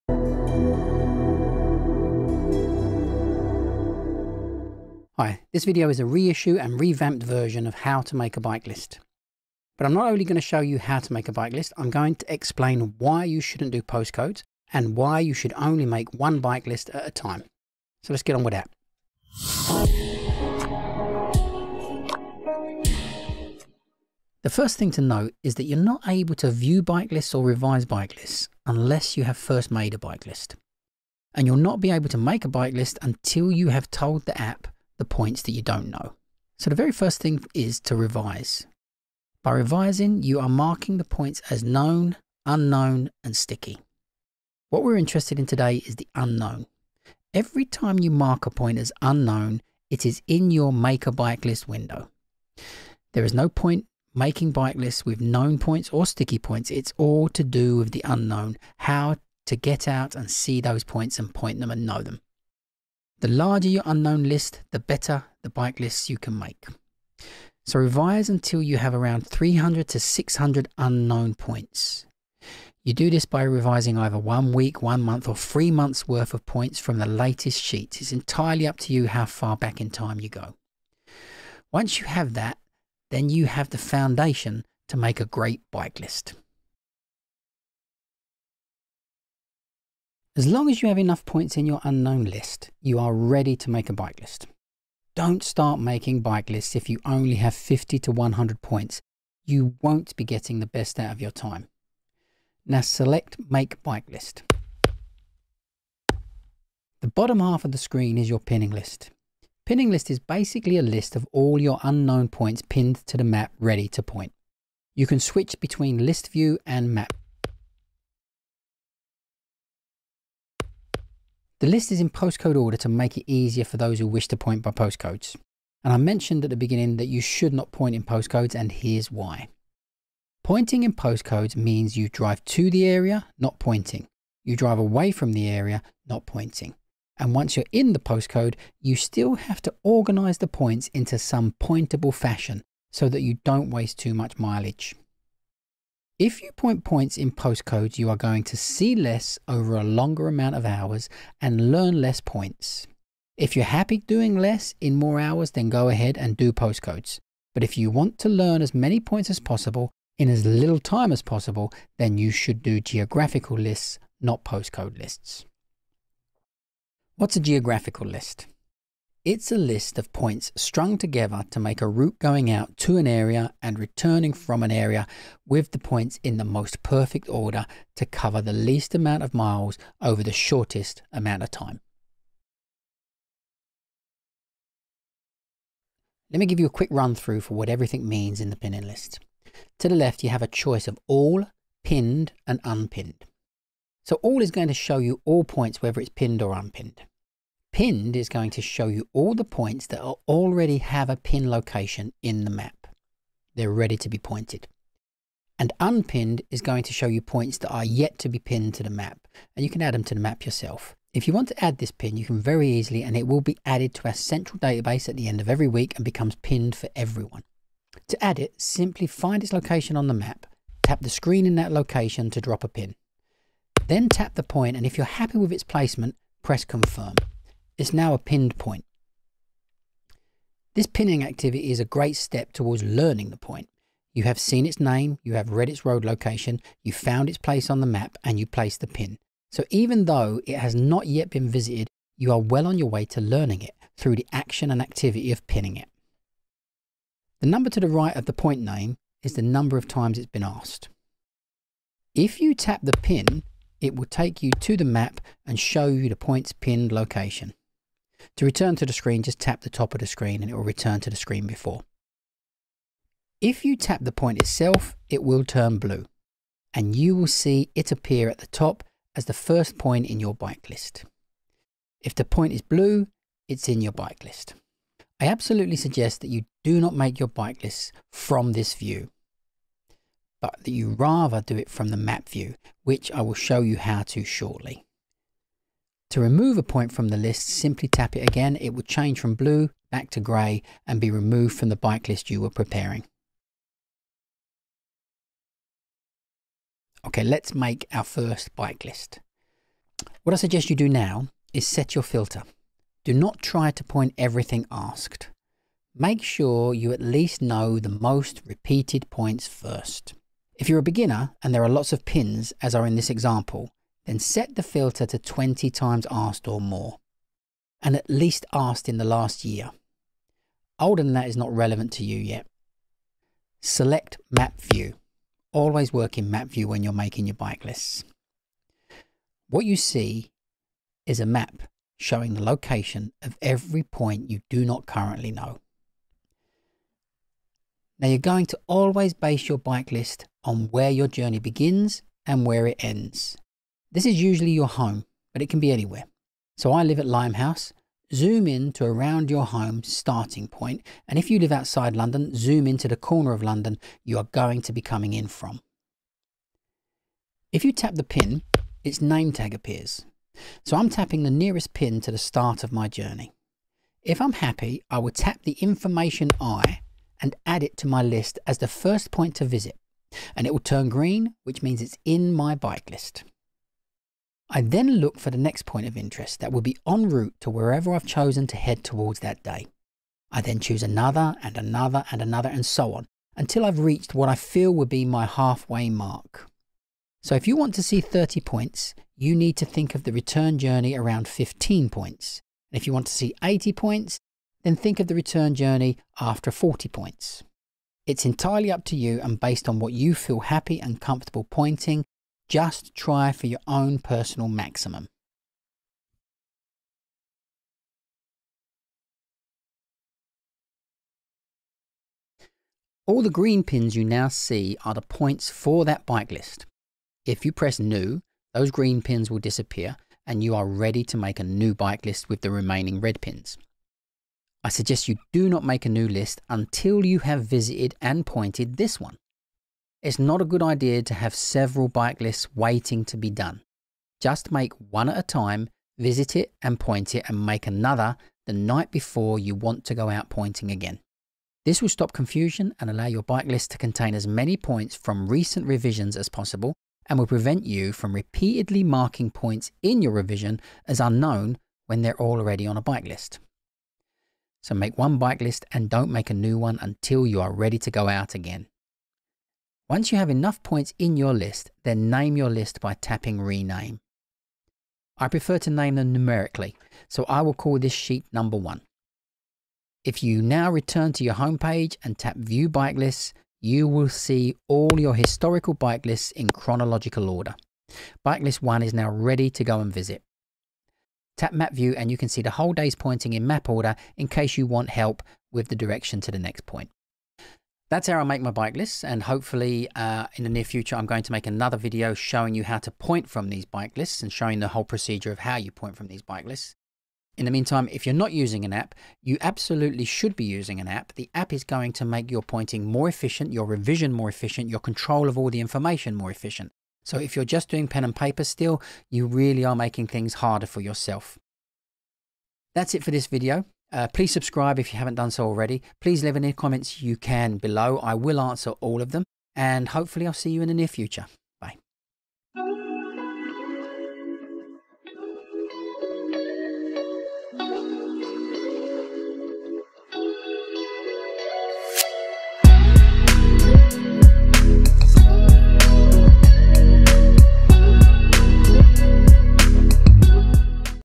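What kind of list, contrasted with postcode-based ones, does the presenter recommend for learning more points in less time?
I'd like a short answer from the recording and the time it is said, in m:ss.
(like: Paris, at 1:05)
geographical lists, at 2:42.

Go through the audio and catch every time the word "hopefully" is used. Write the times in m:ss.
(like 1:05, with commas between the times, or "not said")
8:09, 8:39.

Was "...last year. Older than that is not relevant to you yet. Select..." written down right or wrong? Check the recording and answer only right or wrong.
right.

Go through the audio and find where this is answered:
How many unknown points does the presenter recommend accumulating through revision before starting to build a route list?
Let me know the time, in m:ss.
1:09.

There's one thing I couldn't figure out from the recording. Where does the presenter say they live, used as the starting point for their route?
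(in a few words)
Limehouse.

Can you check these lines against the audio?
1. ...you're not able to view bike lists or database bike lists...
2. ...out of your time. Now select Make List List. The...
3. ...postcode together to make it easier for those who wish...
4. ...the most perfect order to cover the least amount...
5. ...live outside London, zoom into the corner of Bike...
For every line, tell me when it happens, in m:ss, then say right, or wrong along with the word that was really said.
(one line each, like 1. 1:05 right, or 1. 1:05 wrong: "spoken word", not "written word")
1. 0:25 wrong: "revise", not "database"
2. 1:41 wrong: "Bike", not "List"
3. 2:02 wrong: "order", not "together"
4. 2:56 right
5. 5:51 wrong: "London", not "Bike".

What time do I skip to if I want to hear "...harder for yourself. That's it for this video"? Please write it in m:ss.
8:30.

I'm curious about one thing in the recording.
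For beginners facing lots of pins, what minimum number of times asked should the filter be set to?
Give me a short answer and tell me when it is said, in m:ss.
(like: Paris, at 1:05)
20, at 5:15.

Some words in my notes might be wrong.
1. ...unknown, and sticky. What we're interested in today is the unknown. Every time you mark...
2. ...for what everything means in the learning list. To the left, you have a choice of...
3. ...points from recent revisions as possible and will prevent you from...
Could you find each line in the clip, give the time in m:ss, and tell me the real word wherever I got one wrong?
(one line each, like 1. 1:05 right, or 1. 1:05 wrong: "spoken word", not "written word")
1. 0:42 right
2. 3:07 wrong: "pinning", not "learning"
3. 7:24 right.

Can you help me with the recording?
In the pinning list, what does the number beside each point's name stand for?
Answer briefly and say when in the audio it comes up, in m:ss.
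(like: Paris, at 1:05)
times it's been asked, at 4:09.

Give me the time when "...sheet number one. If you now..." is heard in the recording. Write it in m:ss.
7:47.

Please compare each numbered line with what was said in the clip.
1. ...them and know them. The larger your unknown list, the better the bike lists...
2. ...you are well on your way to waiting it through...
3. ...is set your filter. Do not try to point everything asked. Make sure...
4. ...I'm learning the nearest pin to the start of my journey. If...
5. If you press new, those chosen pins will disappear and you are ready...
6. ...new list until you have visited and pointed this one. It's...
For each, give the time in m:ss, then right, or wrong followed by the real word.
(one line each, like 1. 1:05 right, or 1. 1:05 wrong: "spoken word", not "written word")
1. 1:01 right
2. 4:02 wrong: "learning", not "waiting"
3. 5:01 right
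4. 6:00 wrong: "tapping", not "learning"
5. 6:57 wrong: "green", not "chosen"
6. 7:05 right.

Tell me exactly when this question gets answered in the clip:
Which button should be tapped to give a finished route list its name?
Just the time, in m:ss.
7:43.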